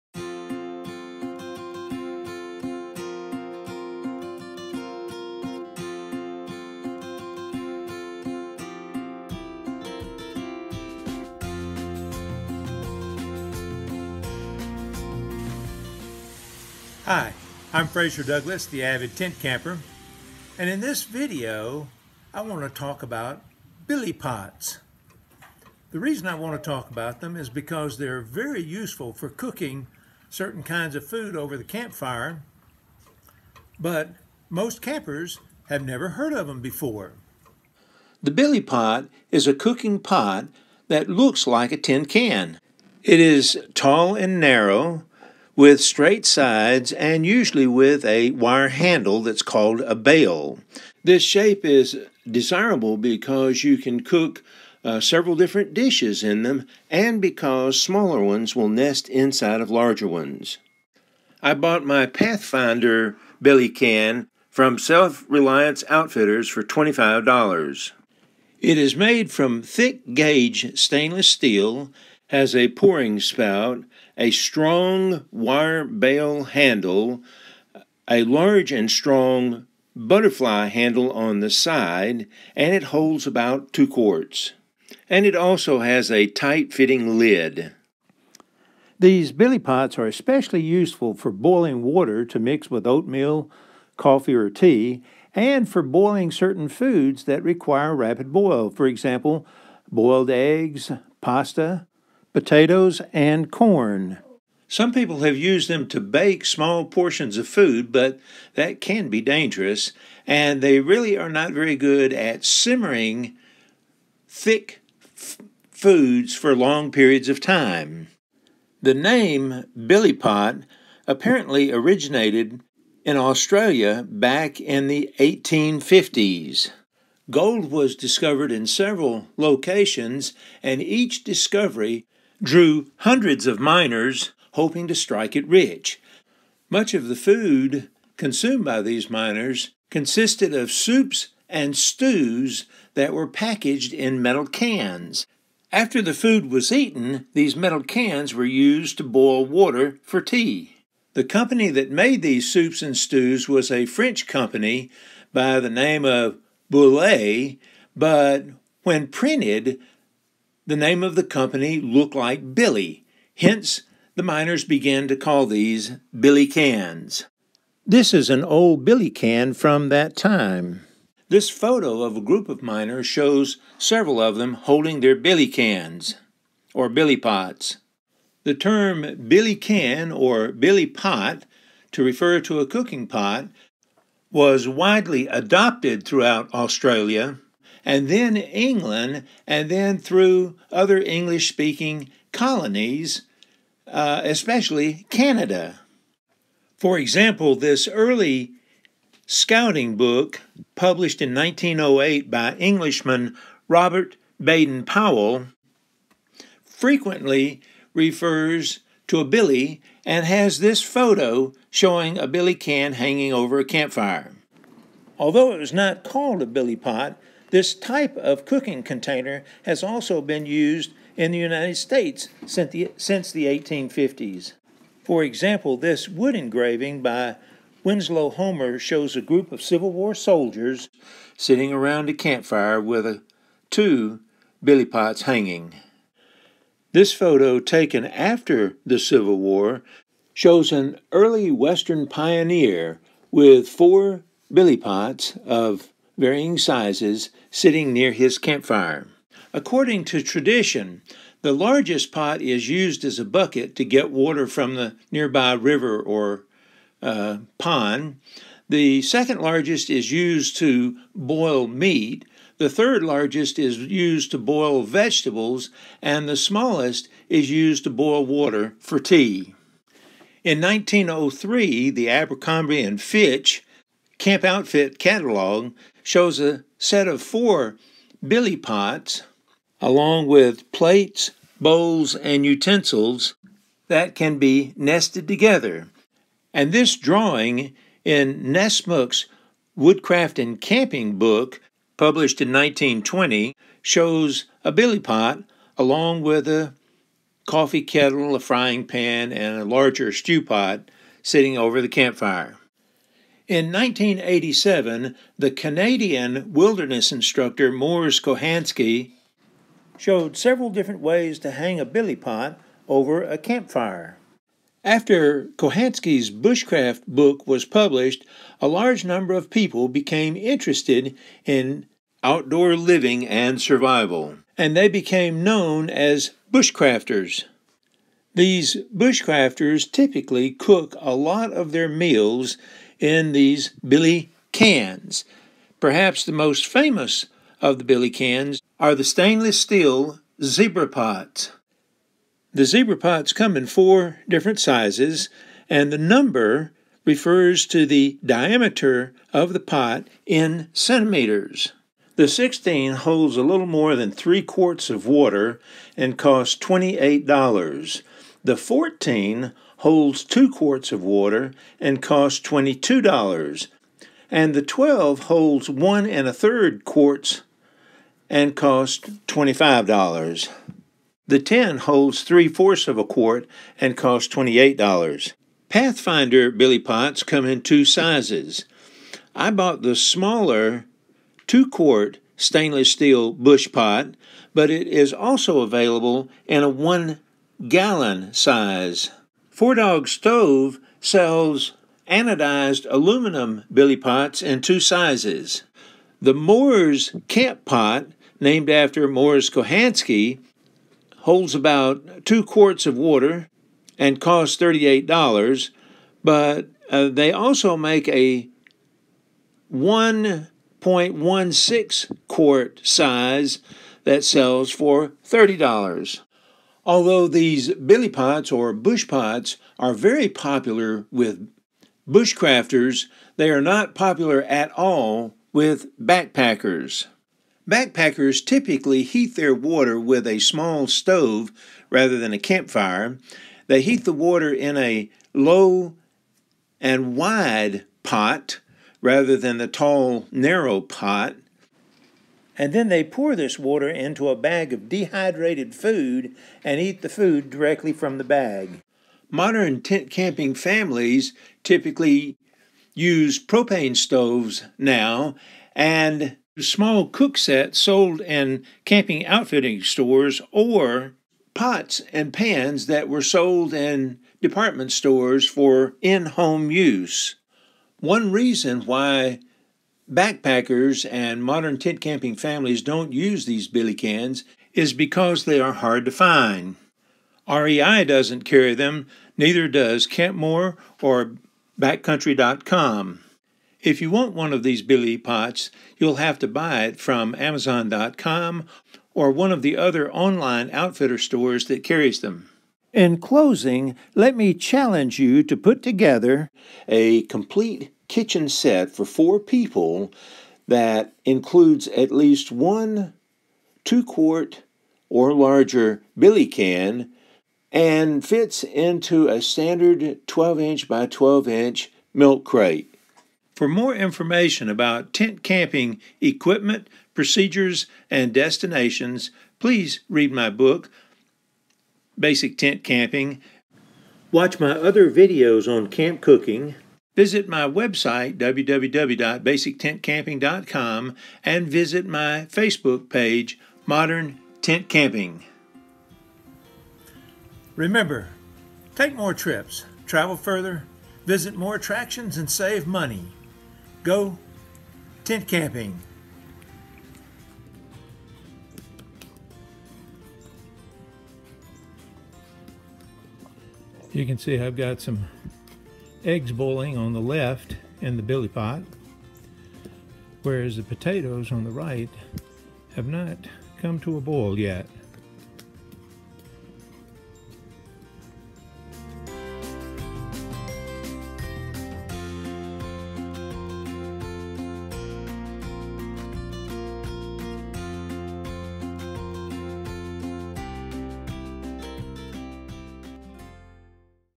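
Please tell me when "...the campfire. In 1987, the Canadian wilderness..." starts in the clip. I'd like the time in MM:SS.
05:01.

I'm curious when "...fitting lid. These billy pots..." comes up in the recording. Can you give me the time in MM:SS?
01:26.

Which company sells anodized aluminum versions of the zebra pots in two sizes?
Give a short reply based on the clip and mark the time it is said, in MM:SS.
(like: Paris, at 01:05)
Four Dog Stove, at 06:29.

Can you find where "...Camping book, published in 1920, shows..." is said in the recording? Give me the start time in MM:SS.
04:50.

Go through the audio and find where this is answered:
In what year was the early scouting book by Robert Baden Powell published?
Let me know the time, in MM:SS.
03:21.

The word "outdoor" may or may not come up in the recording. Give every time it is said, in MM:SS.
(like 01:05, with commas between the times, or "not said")
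05:22.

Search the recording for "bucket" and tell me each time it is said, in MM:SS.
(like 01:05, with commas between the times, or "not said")
04:13.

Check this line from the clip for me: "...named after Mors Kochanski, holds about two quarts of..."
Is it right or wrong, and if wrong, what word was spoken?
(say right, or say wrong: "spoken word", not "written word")
right.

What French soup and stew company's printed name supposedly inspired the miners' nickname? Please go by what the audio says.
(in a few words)
Boulay.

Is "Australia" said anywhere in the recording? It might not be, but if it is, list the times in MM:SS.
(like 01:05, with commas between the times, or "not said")
02:03, 03:06.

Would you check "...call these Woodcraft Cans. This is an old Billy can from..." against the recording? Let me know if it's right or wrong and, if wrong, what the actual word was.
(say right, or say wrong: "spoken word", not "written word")
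wrong: "Billy", not "Woodcraft".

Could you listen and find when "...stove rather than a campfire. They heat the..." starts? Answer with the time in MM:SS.
07:10.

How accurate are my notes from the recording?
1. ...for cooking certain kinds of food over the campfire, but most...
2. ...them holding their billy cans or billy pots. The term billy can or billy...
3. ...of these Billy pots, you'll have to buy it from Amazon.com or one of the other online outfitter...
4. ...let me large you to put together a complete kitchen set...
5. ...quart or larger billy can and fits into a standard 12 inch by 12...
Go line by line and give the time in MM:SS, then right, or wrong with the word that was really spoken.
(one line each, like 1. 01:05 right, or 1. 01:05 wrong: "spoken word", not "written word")
1. 00:29 right
2. 02:54 right
3. 08:04 right
4. 08:14 wrong: "challenge", not "large"
5. 08:24 right.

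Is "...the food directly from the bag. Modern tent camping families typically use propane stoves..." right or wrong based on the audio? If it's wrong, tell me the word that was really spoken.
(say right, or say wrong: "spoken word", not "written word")
right.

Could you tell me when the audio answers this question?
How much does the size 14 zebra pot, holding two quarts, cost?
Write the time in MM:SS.
06:02.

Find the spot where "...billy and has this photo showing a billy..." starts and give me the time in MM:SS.
03:29.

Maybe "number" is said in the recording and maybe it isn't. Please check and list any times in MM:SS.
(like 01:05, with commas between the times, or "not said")
05:19, 05:45.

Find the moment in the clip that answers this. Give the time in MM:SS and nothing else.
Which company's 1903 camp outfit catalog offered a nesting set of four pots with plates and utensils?
04:32.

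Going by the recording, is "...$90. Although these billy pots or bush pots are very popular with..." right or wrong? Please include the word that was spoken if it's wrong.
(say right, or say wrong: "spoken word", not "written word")
wrong: "30", not "90".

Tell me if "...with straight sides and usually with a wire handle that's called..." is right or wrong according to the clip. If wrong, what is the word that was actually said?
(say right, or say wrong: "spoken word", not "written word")
right.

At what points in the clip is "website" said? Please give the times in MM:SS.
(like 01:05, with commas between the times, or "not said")
08:47.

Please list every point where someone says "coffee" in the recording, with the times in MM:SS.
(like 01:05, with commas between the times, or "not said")
01:33, 04:57.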